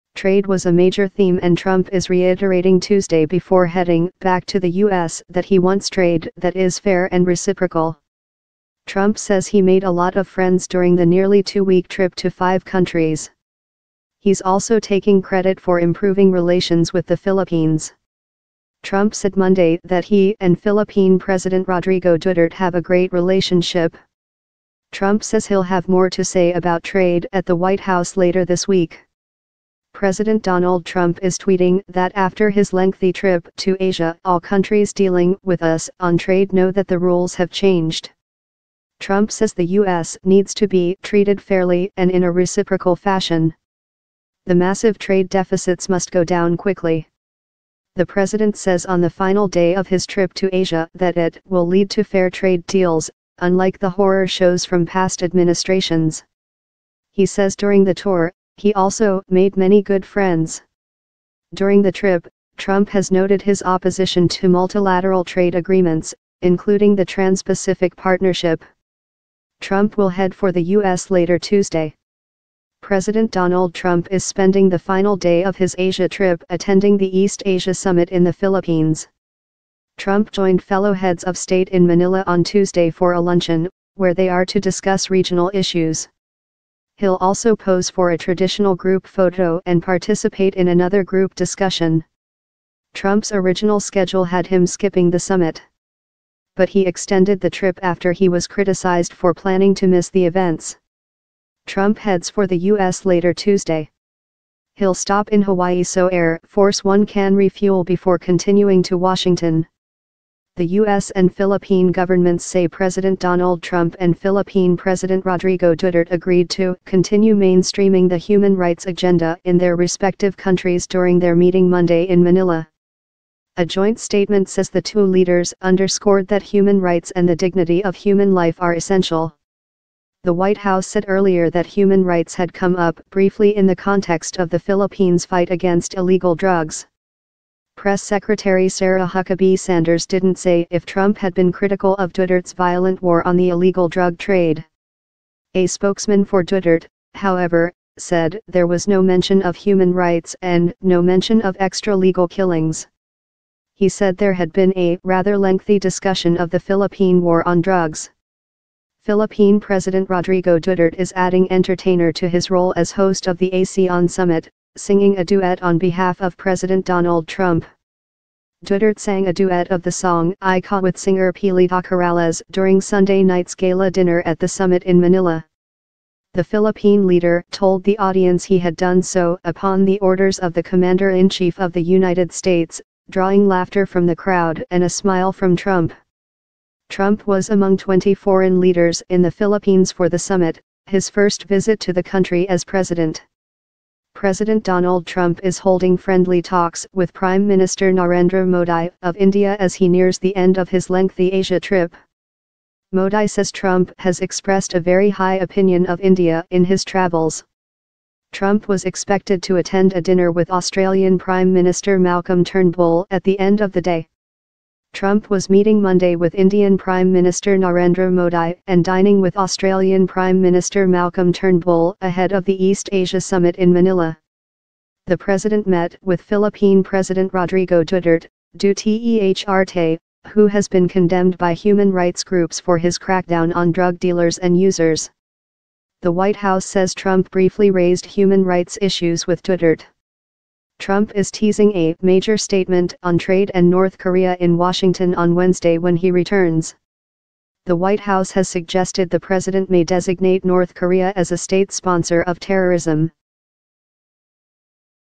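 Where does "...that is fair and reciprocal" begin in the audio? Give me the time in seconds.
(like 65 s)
6 s.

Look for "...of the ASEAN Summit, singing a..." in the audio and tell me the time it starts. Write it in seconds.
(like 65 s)
163 s.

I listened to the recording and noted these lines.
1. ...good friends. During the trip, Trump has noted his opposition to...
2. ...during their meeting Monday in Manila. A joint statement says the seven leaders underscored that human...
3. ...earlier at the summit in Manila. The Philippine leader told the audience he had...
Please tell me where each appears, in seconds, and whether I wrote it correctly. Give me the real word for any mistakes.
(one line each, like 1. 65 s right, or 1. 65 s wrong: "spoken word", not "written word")
1. 59 s right
2. 120 s wrong: "two", not "seven"
3. 173 s wrong: "dinner", not "earlier".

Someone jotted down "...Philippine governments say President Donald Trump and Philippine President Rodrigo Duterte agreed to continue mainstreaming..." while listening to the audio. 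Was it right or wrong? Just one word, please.
right.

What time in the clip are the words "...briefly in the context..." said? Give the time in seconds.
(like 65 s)
133 s.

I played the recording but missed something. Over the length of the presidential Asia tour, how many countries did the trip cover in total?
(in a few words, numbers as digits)
5.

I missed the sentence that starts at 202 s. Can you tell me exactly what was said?
Modi says Trump has expressed a very high opinion of India in his travels.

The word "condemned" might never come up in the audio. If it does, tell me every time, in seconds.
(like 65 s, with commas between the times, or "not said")
230 s.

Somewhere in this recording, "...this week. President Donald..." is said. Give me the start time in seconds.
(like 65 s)
28 s.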